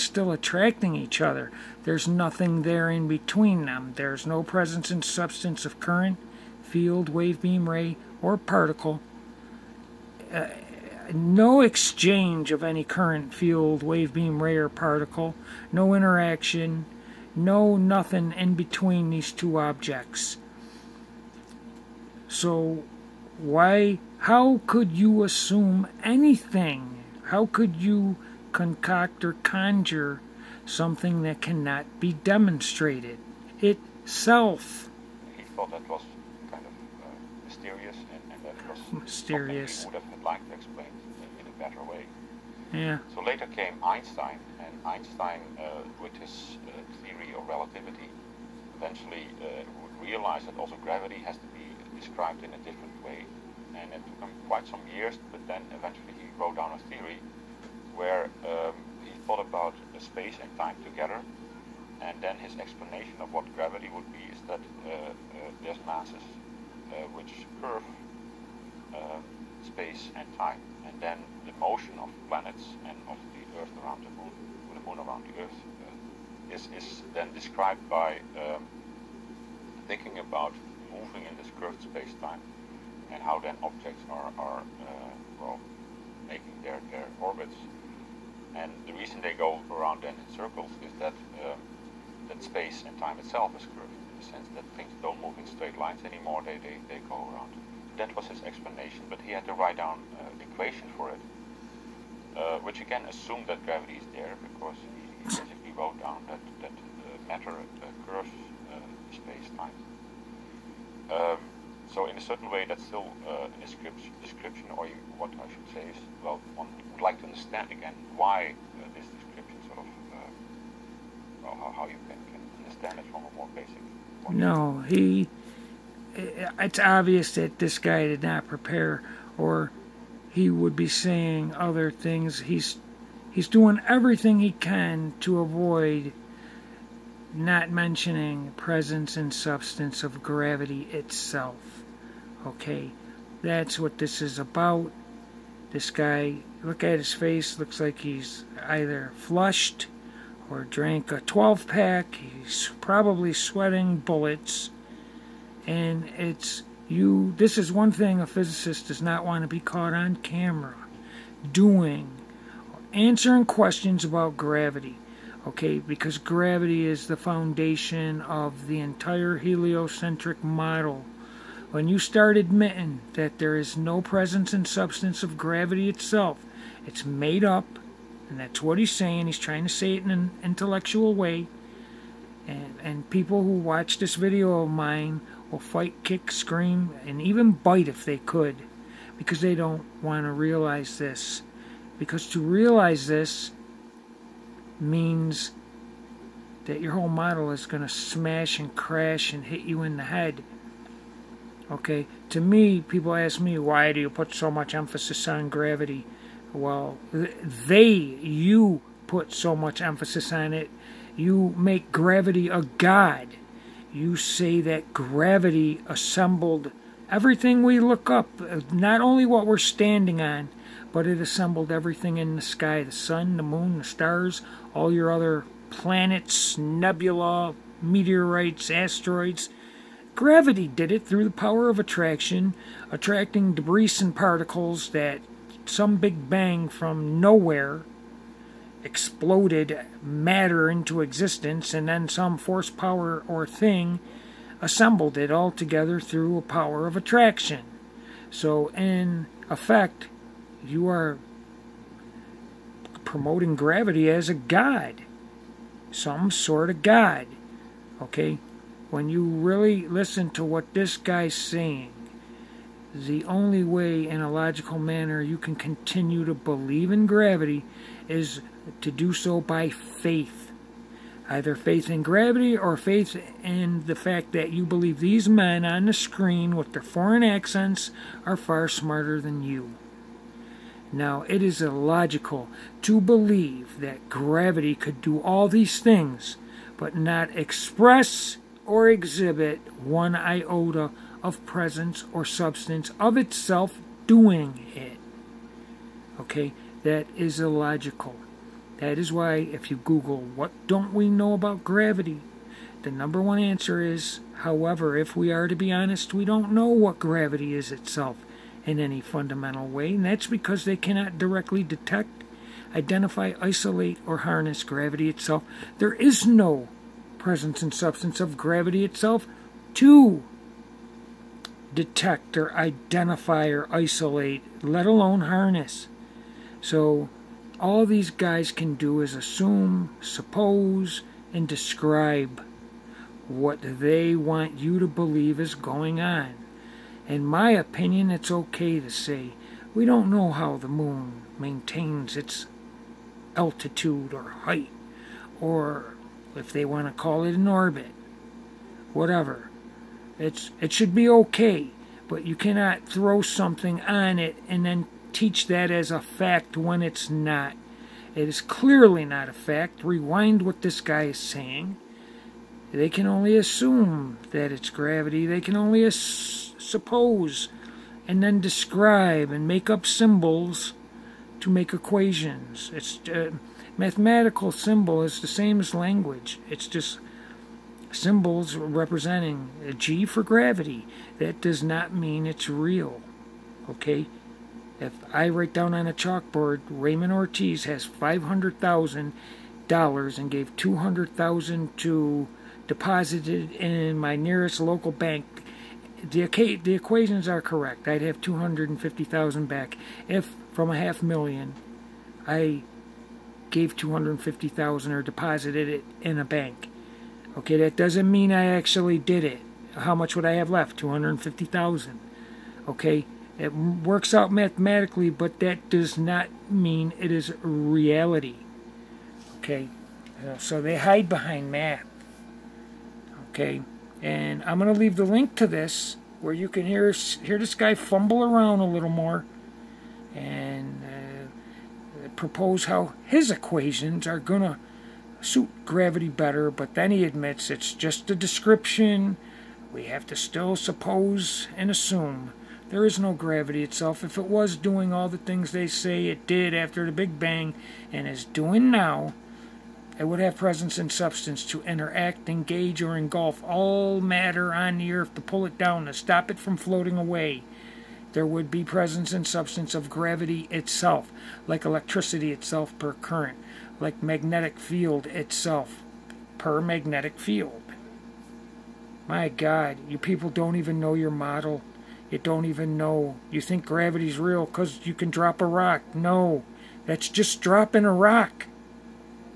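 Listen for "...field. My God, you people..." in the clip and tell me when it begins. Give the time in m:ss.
7:47.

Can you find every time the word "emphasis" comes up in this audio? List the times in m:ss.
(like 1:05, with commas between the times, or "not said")
3:24, 3:29.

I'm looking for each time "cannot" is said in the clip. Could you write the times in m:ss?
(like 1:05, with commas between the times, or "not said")
0:31, 5:10, 5:52.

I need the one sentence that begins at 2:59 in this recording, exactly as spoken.
He's trying to say it in an intellectual way.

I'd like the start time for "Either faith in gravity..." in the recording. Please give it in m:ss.
4:31.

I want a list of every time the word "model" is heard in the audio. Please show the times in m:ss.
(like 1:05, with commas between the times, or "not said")
2:50, 3:17, 7:51.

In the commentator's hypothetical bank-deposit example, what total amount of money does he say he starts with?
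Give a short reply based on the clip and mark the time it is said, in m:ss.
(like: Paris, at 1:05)
$500,000, at 6:27.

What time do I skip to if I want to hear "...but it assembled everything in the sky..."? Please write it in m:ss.
3:40.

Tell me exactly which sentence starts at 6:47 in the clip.
Okay, that doesn't mean I actually did it.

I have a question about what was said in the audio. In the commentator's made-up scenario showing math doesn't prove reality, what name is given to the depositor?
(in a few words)
Ramon Ortiz.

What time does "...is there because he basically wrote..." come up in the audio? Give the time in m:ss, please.
1:43.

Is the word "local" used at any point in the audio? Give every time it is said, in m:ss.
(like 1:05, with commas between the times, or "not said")
6:34.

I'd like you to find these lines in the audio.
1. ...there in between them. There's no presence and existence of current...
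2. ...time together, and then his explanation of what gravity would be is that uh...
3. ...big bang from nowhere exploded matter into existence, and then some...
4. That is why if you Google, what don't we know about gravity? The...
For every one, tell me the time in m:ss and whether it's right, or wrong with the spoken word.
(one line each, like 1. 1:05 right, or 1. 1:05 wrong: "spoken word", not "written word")
1. 0:02 wrong: "substance", not "existence"
2. 1:00 right
3. 3:55 right
4. 4:58 right.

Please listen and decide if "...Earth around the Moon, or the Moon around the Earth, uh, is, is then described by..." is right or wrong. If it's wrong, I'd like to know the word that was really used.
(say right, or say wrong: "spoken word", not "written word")
right.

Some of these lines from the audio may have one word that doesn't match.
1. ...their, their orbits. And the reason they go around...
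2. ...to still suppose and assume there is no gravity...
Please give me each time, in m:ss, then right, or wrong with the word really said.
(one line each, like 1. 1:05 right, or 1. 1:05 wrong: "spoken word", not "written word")
1. 1:26 right
2. 7:20 right.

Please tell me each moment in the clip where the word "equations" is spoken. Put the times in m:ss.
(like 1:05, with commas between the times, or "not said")
1:40, 6:11, 6:36, 7:13.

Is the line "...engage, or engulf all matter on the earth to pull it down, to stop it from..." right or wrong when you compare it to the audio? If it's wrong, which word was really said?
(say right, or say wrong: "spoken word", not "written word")
right.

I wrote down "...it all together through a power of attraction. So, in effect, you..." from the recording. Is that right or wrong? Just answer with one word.
right.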